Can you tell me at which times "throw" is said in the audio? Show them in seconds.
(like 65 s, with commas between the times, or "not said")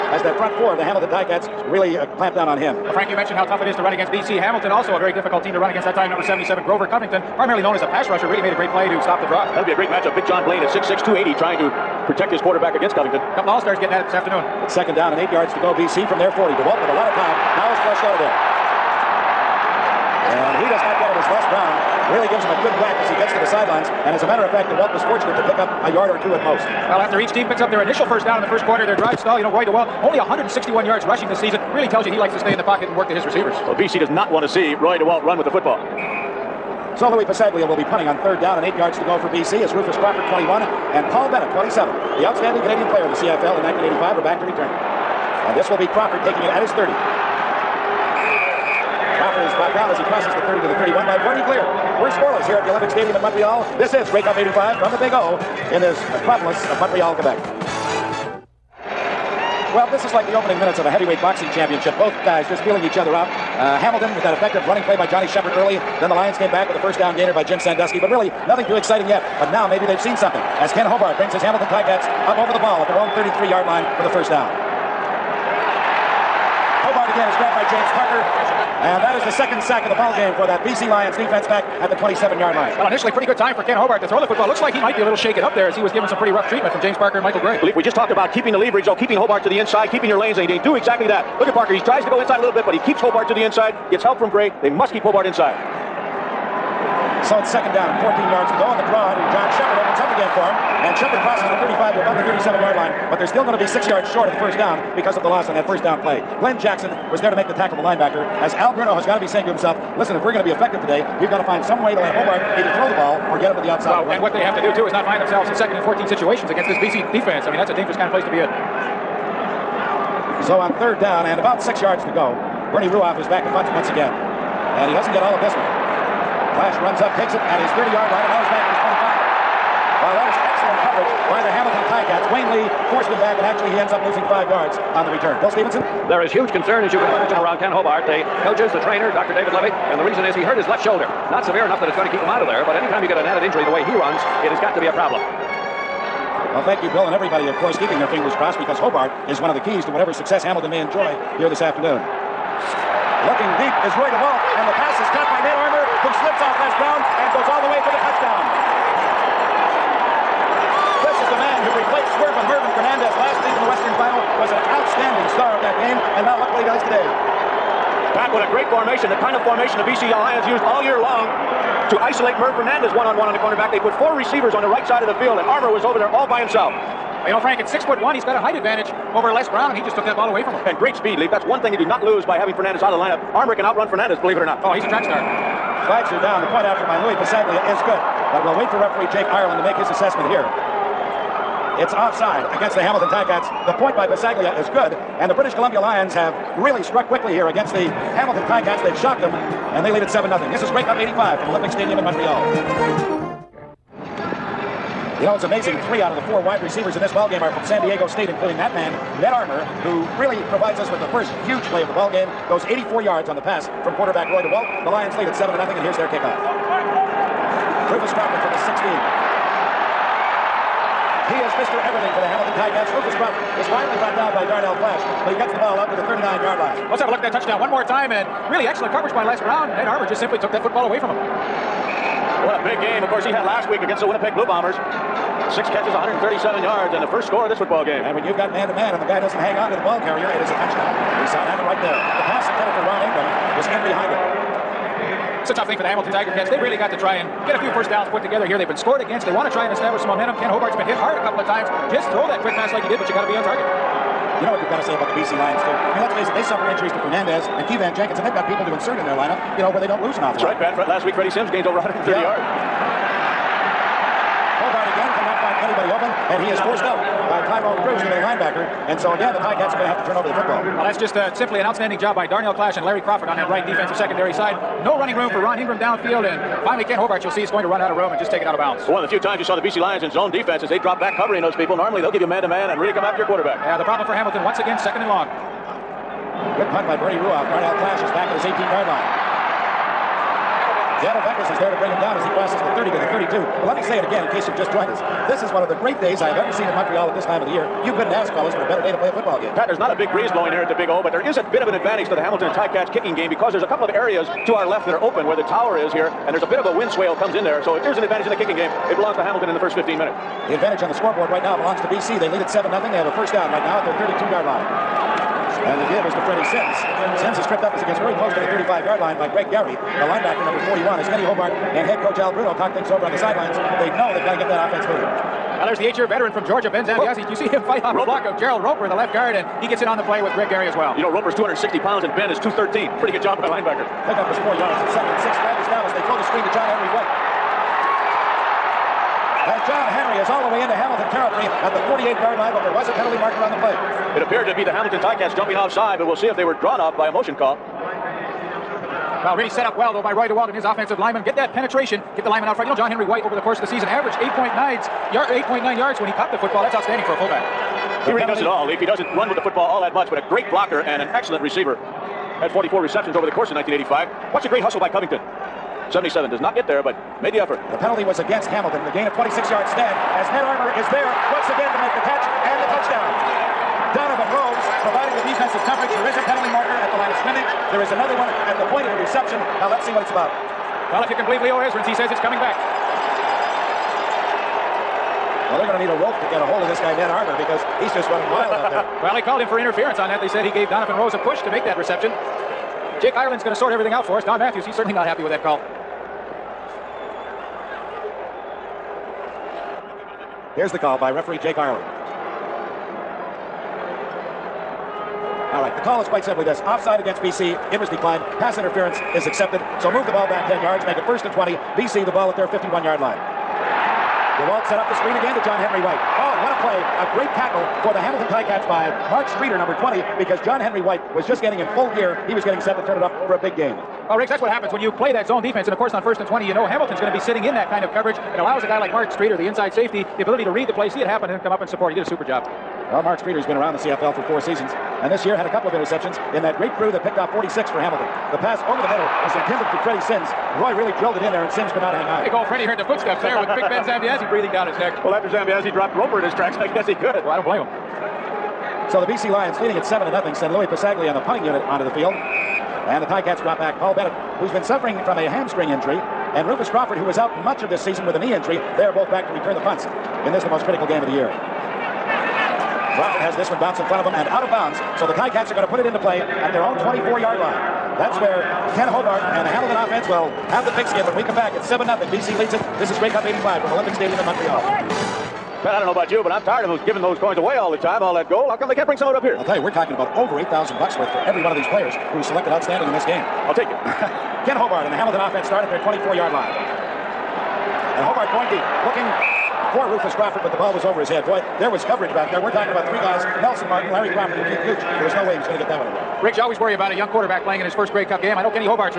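84 s, 112 s, 252 s, 336 s.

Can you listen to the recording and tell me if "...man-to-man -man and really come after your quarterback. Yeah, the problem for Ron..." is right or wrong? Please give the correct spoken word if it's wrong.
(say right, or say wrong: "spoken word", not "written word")
wrong: "Hamilton", not "Ron".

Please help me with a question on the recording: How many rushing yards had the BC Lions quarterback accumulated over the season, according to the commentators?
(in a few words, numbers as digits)
161.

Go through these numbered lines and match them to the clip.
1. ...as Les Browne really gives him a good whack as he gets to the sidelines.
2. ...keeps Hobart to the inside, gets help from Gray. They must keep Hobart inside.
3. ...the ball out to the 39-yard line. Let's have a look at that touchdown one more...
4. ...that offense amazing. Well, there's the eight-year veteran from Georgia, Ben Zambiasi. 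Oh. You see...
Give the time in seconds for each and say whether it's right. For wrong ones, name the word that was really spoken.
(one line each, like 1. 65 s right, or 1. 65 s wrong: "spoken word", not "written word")
1. 21 s right
2. 92 s right
3. 225 s right
4. 324 s wrong: "moving", not "amazing".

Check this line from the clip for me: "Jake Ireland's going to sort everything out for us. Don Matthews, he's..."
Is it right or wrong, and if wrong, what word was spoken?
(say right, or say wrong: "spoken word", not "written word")
right.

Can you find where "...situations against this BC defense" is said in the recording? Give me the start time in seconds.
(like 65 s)
116 s.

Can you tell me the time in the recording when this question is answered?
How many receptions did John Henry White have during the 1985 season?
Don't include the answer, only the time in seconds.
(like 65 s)
362 s.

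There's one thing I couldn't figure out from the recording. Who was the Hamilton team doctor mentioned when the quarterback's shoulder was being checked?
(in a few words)
Dr. David Levy.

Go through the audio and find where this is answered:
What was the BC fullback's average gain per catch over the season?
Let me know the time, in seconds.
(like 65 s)
355 s.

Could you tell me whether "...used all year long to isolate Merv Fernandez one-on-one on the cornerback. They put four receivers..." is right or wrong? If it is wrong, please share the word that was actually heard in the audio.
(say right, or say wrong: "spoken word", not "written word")
right.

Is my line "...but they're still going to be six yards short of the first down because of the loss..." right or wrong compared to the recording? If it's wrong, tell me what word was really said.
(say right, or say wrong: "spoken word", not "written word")
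right.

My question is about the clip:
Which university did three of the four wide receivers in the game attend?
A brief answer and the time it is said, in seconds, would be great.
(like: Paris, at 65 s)
San Diego State, at 207 s.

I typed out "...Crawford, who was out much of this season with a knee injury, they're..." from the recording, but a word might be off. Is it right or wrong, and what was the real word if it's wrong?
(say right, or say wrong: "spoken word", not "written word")
right.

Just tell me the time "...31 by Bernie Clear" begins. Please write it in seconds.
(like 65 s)
50 s.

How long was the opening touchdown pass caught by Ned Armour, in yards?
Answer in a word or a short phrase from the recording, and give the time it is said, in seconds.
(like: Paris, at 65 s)
84, at 212 s.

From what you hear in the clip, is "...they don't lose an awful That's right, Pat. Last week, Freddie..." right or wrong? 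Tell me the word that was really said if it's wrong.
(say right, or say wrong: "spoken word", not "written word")
right.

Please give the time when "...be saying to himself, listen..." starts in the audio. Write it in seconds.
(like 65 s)
109 s.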